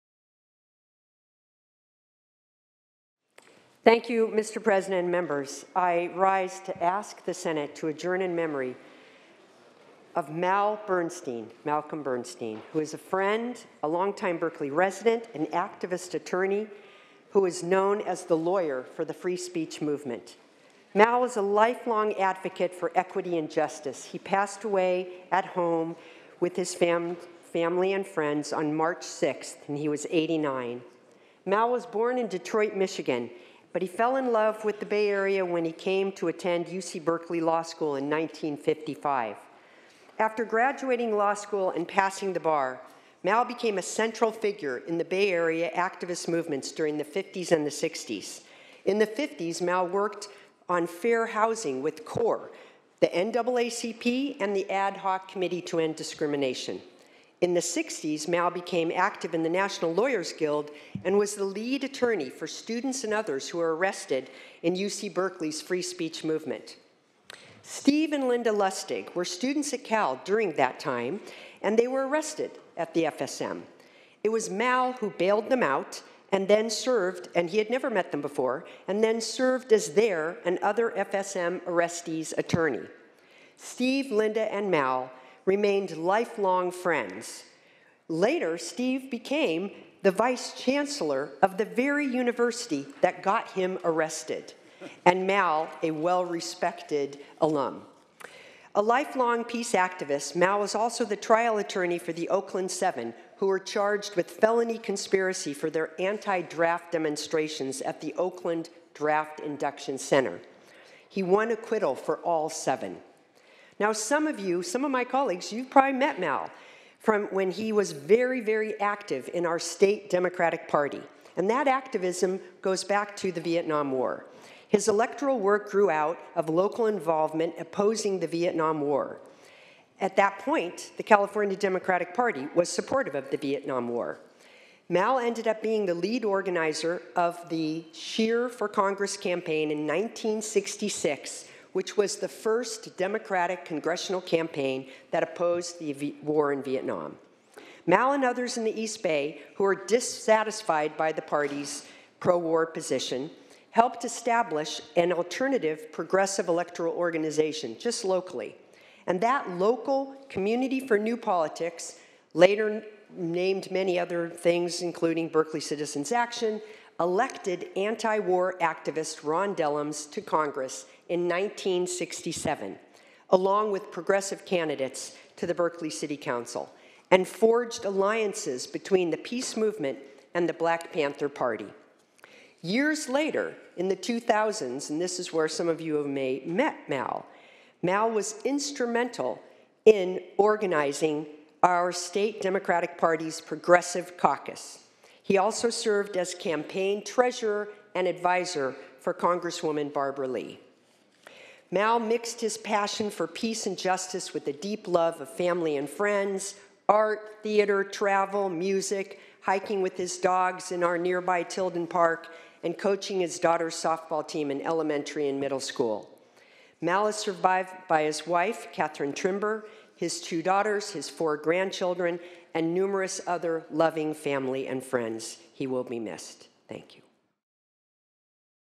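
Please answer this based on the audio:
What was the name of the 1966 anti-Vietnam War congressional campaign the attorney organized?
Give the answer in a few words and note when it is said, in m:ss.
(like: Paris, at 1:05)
Scheer for Congress, at 2:17.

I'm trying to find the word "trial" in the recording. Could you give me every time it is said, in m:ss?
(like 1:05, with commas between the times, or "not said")
1:41.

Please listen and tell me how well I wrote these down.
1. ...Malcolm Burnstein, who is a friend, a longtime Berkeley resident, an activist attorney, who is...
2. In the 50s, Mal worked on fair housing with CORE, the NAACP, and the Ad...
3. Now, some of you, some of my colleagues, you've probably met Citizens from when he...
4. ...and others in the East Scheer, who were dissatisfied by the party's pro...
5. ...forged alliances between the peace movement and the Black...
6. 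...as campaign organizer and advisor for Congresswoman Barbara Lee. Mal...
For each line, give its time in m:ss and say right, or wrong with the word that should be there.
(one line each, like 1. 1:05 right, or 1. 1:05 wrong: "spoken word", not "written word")
1. 0:11 right
2. 0:48 right
3. 1:53 wrong: "Mal", not "Citizens"
4. 2:28 wrong: "Bay", not "Scheer"
5. 2:57 right
6. 3:16 wrong: "treasurer", not "organizer".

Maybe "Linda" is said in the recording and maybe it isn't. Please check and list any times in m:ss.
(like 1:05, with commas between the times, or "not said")
1:08, 1:24.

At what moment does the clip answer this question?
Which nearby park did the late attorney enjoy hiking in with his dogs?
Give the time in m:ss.
3:31.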